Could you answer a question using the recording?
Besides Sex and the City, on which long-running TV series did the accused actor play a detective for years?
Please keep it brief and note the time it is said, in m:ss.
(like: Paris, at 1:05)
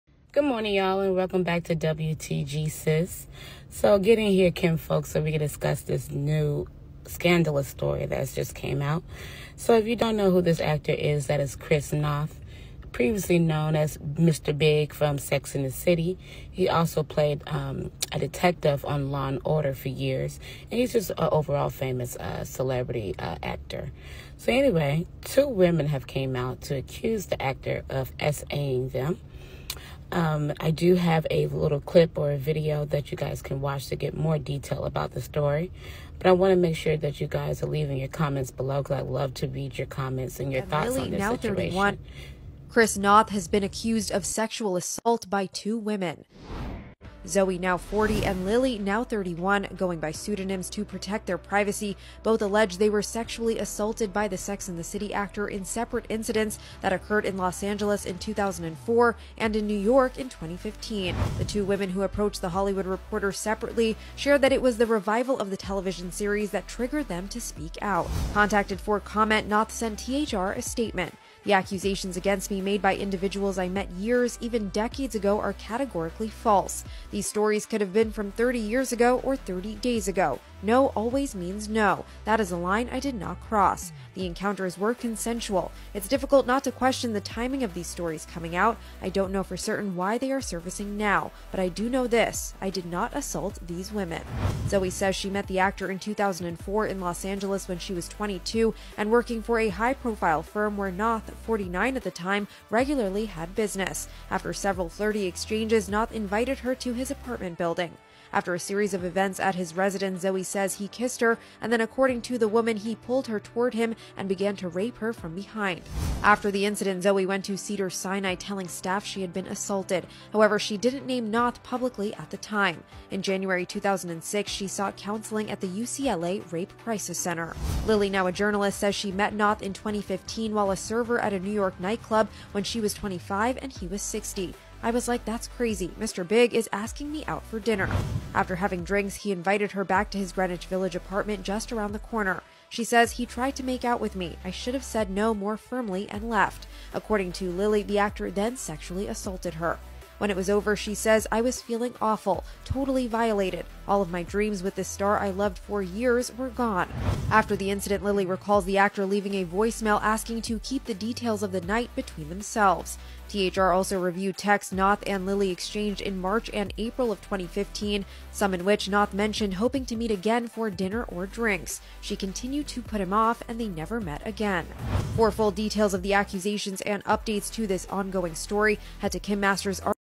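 Law and Order, at 0:19.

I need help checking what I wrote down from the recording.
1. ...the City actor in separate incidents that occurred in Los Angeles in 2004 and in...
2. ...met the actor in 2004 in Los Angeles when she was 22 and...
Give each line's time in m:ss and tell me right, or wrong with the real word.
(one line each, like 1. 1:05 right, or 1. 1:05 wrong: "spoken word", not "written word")
1. 0:54 right
2. 1:35 right.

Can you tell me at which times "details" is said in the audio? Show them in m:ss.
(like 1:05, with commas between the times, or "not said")
0:34, 2:40, 2:55.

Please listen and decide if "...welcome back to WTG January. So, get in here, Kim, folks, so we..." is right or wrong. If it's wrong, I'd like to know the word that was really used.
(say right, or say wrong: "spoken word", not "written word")
wrong: "Sis", not "January".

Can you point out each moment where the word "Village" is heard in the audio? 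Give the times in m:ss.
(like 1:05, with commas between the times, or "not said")
2:20.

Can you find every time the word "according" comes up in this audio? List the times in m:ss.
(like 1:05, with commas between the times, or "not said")
1:51, 2:26.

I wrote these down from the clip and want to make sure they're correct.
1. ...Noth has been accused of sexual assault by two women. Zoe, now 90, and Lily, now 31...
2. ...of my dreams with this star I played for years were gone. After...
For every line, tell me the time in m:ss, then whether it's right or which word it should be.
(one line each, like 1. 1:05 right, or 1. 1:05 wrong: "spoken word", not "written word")
1. 0:42 wrong: "40", not "90"
2. 2:34 wrong: "loved", not "played".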